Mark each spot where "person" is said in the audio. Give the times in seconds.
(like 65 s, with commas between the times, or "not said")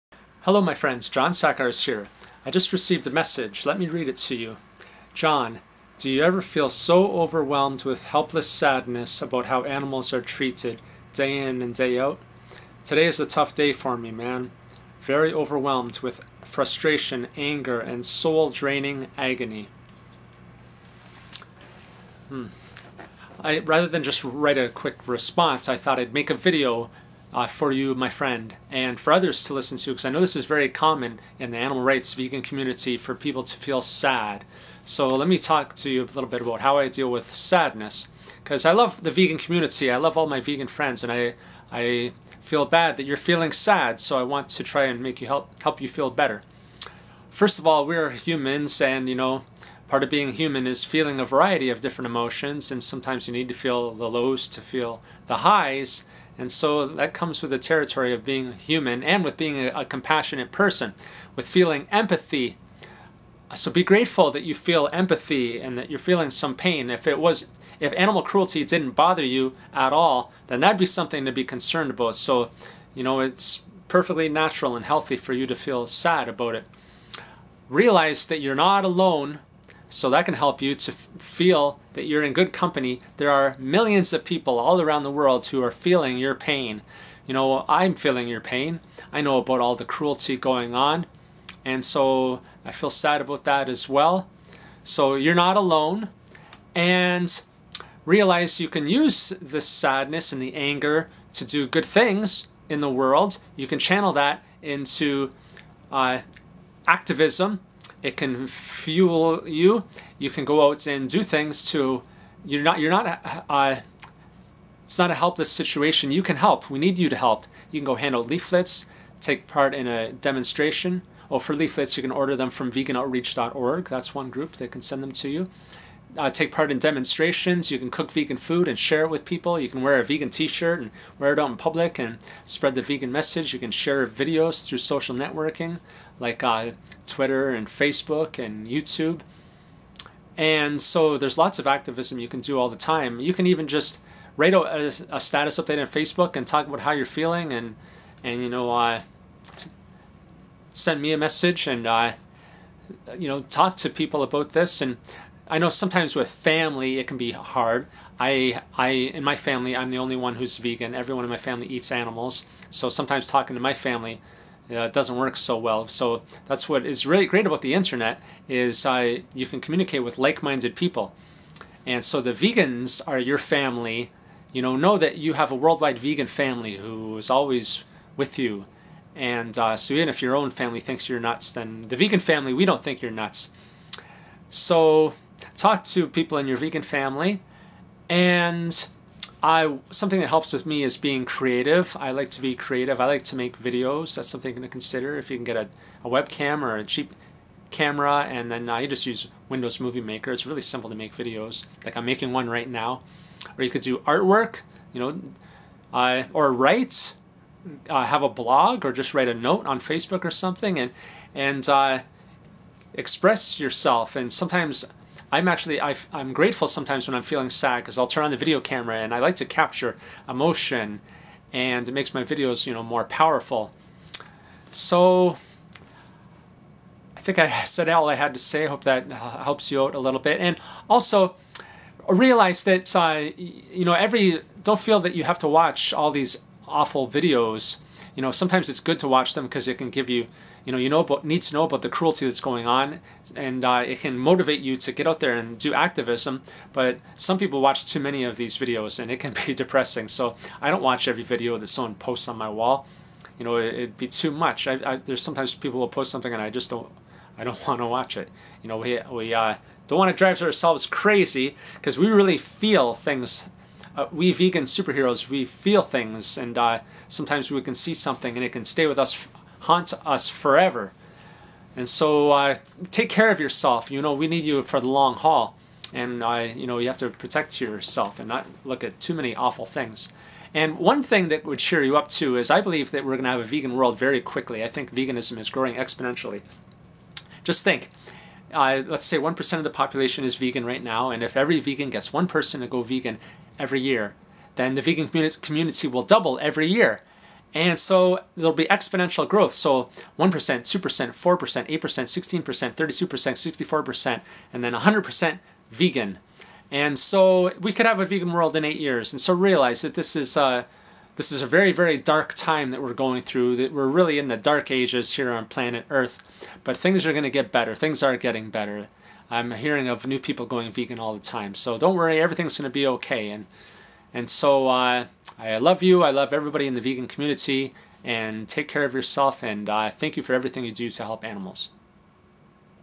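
60 s, 292 s.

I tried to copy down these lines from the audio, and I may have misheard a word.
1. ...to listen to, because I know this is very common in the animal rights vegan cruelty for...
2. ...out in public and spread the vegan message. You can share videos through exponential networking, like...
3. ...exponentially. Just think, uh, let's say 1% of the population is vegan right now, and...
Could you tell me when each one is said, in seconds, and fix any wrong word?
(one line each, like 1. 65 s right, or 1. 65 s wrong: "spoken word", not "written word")
1. 29 s wrong: "community", not "cruelty"
2. 131 s wrong: "social", not "exponential"
3. 285 s right.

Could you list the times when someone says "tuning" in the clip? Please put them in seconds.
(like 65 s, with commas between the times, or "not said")
not said.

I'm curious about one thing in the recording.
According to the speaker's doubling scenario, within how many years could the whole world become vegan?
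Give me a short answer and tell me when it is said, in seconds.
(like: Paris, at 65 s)
8 years, at 308 s.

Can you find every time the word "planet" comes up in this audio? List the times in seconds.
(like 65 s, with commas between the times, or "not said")
315 s.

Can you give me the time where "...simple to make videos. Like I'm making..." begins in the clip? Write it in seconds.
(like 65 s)
200 s.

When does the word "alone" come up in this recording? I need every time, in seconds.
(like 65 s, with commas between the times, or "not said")
78 s, 95 s.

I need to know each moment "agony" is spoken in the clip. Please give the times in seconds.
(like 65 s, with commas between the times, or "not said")
19 s.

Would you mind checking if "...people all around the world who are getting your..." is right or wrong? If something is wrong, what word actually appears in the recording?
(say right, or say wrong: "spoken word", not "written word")
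wrong: "feeling", not "getting".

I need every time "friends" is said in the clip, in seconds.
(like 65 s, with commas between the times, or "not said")
0 s, 28 s, 40 s.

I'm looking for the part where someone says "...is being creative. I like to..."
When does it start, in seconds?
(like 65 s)
190 s.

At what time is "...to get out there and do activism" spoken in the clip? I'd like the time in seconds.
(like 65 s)
244 s.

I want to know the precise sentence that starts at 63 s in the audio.
So be grateful that you feel empathy and that you're feeling some pain.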